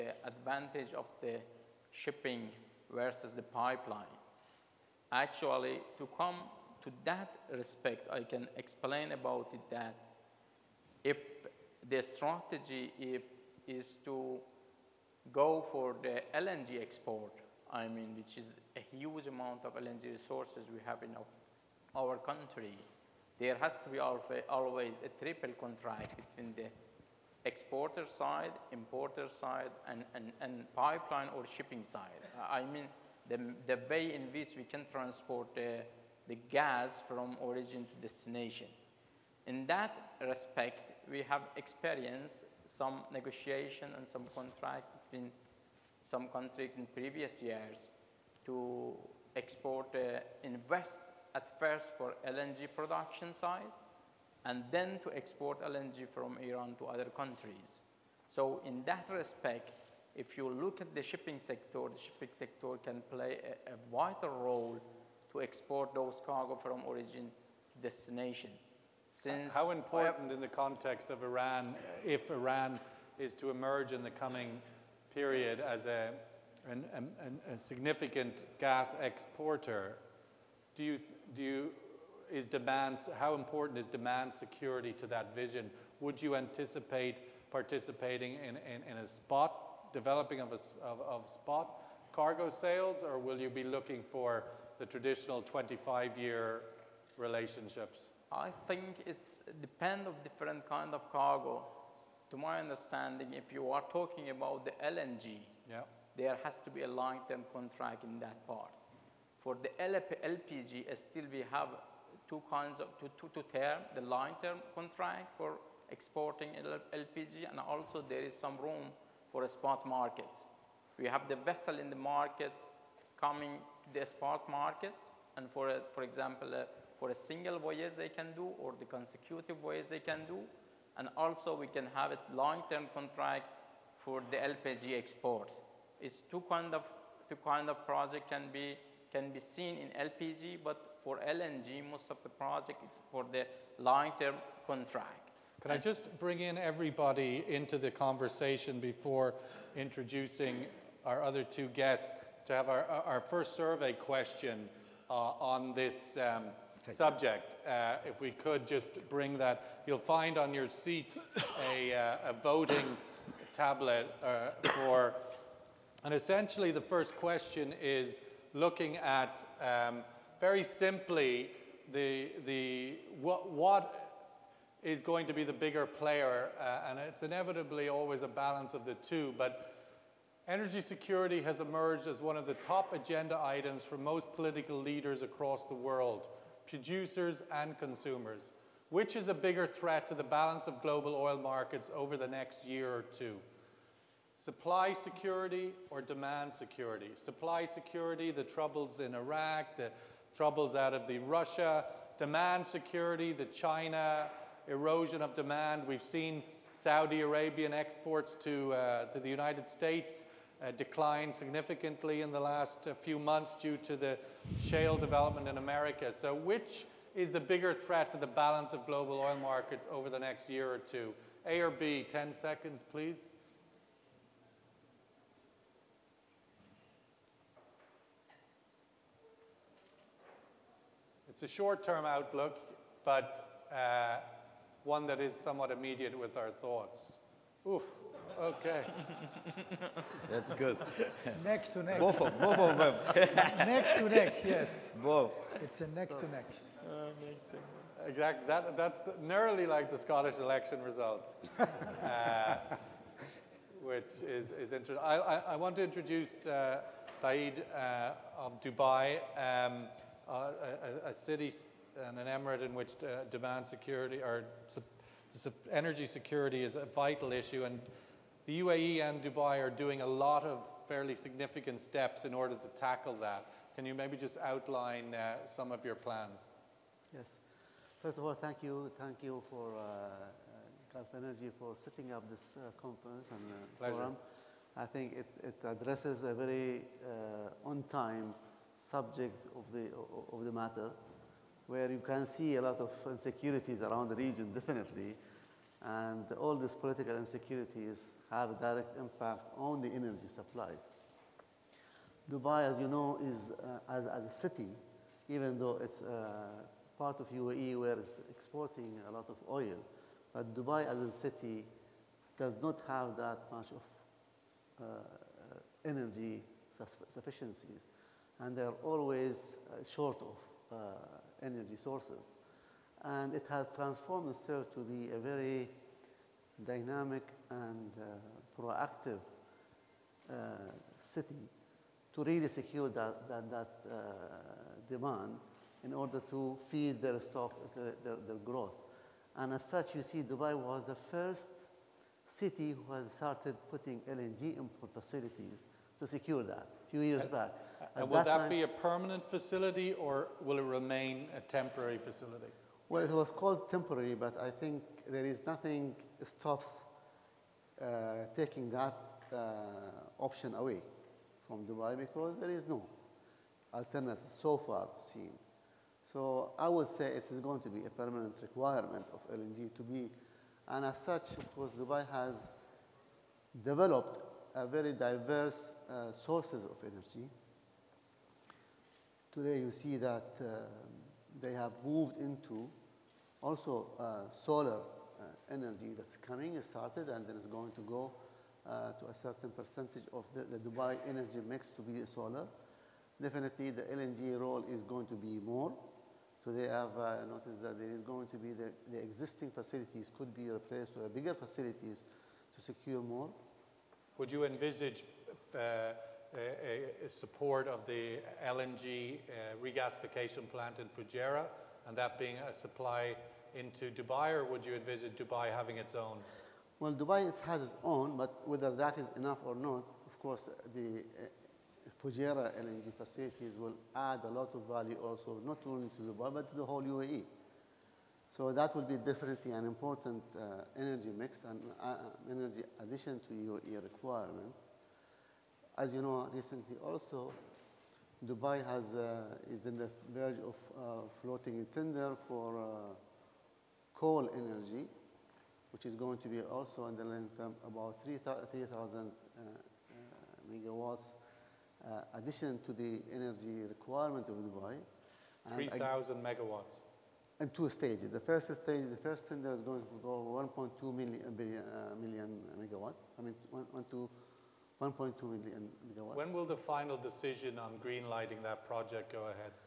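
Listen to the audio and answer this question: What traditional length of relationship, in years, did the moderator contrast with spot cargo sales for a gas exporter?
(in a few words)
25-year.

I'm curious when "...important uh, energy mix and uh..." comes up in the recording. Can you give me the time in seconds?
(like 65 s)
429 s.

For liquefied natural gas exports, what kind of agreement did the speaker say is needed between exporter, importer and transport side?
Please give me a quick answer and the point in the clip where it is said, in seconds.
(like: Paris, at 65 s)
triple contract, at 25 s.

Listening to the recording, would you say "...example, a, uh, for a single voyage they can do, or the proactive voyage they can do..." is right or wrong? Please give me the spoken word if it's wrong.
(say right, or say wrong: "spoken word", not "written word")
wrong: "consecutive", not "proactive".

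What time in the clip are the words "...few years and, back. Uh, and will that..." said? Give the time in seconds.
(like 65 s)
346 s.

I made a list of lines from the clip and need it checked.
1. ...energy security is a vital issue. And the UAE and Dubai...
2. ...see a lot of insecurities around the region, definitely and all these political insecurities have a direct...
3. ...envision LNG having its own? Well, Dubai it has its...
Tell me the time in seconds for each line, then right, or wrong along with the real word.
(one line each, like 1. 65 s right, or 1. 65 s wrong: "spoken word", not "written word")
1. 265 s right
2. 292 s right
3. 414 s wrong: "Dubai", not "LNG".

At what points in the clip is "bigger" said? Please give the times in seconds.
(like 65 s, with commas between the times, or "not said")
175 s, 189 s, 217 s, 401 s.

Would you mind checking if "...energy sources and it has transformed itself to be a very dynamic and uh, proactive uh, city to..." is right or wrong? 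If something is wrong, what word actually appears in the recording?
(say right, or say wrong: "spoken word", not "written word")
right.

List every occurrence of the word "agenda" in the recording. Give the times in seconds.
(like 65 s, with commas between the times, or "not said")
182 s.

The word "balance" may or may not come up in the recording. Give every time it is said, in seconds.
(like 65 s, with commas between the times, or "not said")
178 s, 190 s, 218 s.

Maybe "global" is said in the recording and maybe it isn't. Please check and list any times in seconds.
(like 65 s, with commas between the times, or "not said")
190 s, 218 s.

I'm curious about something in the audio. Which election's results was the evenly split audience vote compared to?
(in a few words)
Scottish election.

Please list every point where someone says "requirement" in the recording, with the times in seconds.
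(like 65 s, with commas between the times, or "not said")
368 s, 433 s, 453 s.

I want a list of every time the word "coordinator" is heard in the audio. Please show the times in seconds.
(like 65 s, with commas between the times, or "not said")
not said.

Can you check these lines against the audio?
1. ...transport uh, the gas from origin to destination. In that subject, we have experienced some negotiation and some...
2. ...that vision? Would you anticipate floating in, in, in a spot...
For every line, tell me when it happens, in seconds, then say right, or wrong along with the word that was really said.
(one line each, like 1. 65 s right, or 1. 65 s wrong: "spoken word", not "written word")
1. 34 s wrong: "respect", not "subject"
2. 85 s wrong: "participating", not "floating".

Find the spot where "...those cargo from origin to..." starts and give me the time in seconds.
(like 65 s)
65 s.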